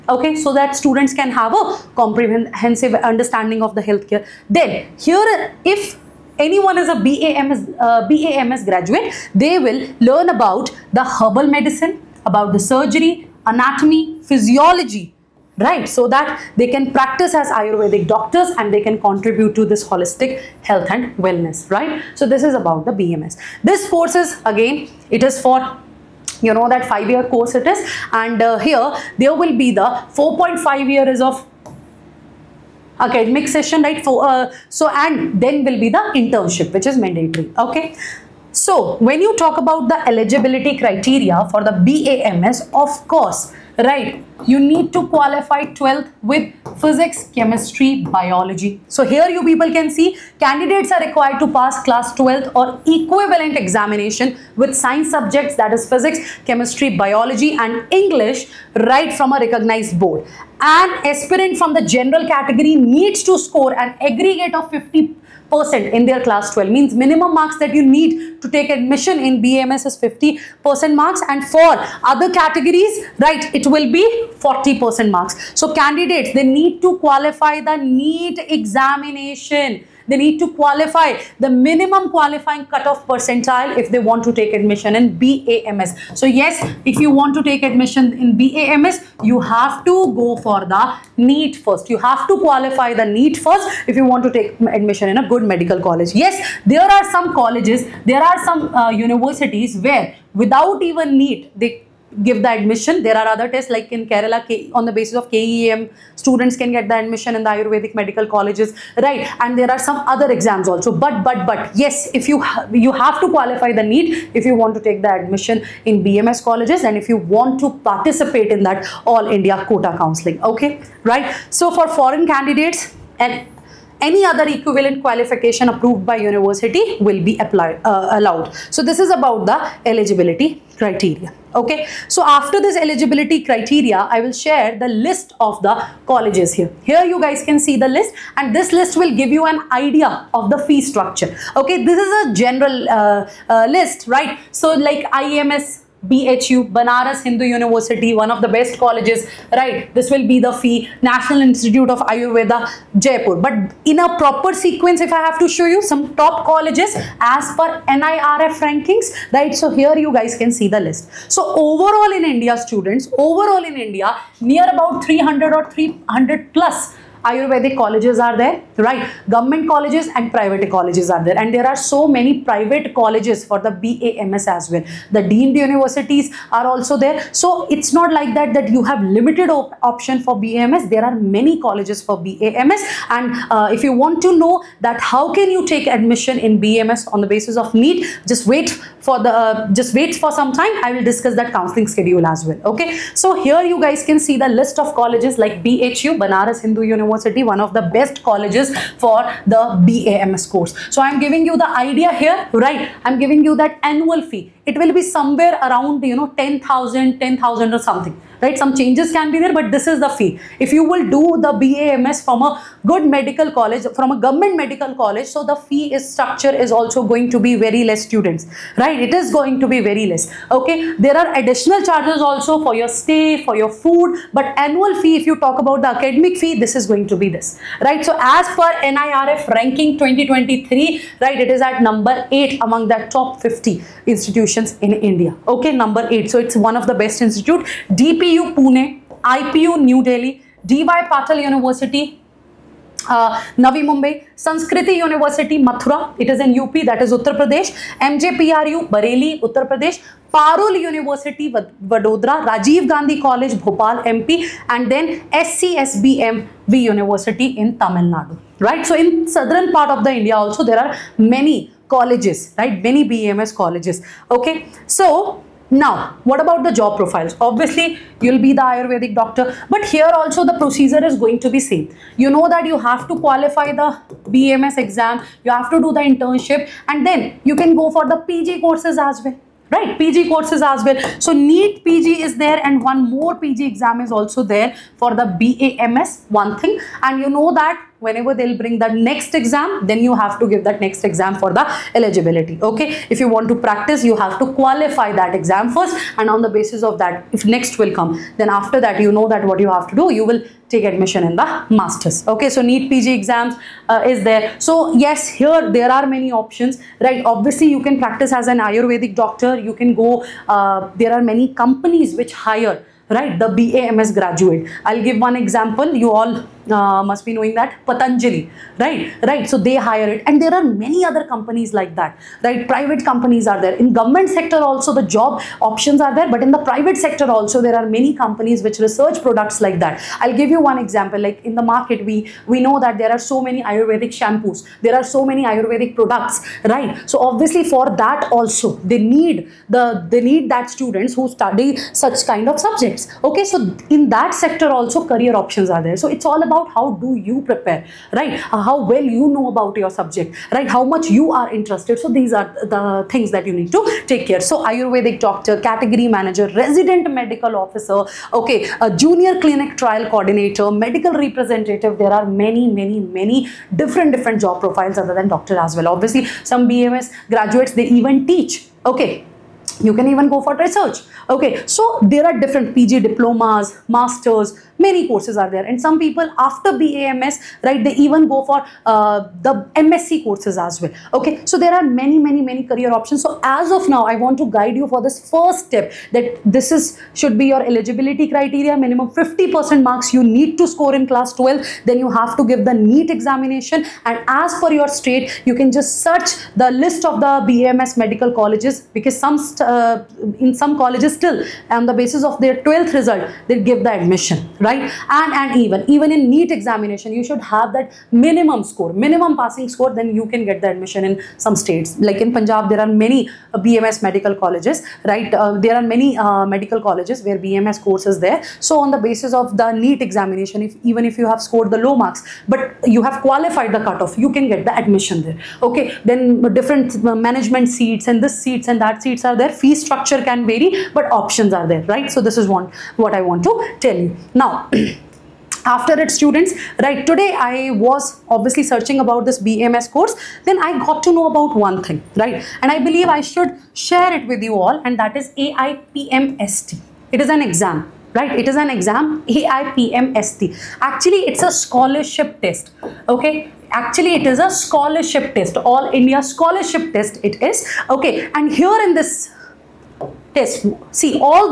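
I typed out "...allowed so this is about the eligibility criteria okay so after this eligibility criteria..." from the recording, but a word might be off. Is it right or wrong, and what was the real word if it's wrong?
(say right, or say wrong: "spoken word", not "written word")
right.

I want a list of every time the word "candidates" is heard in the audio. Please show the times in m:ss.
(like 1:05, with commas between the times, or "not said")
0:50, 1:15, 2:02.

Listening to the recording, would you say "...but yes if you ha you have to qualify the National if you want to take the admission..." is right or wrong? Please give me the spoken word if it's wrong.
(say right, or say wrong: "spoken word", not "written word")
wrong: "NEET", not "National".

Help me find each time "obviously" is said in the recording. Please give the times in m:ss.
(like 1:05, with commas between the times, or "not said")
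4:27, 5:07, 5:37, 6:05, 7:18.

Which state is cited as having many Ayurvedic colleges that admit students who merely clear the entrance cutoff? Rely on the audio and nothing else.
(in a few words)
Punjab.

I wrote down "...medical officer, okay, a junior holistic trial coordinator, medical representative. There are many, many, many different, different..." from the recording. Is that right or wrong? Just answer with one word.
wrong.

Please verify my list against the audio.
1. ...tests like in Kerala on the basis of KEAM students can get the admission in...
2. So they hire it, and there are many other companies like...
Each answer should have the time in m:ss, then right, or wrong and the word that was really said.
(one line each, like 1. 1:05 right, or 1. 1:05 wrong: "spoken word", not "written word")
1. 1:43 right
2. 5:19 right.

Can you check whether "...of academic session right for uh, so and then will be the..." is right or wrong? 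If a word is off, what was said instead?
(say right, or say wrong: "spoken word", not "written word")
right.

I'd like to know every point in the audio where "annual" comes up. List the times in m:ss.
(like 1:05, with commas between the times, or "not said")
3:23, 3:44.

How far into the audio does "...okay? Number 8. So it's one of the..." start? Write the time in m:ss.
3:55.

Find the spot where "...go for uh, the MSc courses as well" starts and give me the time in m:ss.
6:18.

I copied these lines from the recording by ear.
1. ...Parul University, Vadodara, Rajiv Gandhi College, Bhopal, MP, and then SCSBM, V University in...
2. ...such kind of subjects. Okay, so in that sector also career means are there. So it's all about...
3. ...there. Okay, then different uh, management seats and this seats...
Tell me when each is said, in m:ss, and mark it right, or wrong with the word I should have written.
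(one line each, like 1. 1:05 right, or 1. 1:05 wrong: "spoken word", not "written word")
1. 4:10 right
2. 5:41 wrong: "options", not "means"
3. 7:05 right.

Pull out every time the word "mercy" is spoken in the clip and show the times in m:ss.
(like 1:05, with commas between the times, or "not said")
not said.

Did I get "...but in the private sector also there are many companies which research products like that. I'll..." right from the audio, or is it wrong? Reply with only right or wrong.
right.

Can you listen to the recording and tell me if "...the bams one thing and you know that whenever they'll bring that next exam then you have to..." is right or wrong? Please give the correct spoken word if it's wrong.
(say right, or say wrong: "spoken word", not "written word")
right.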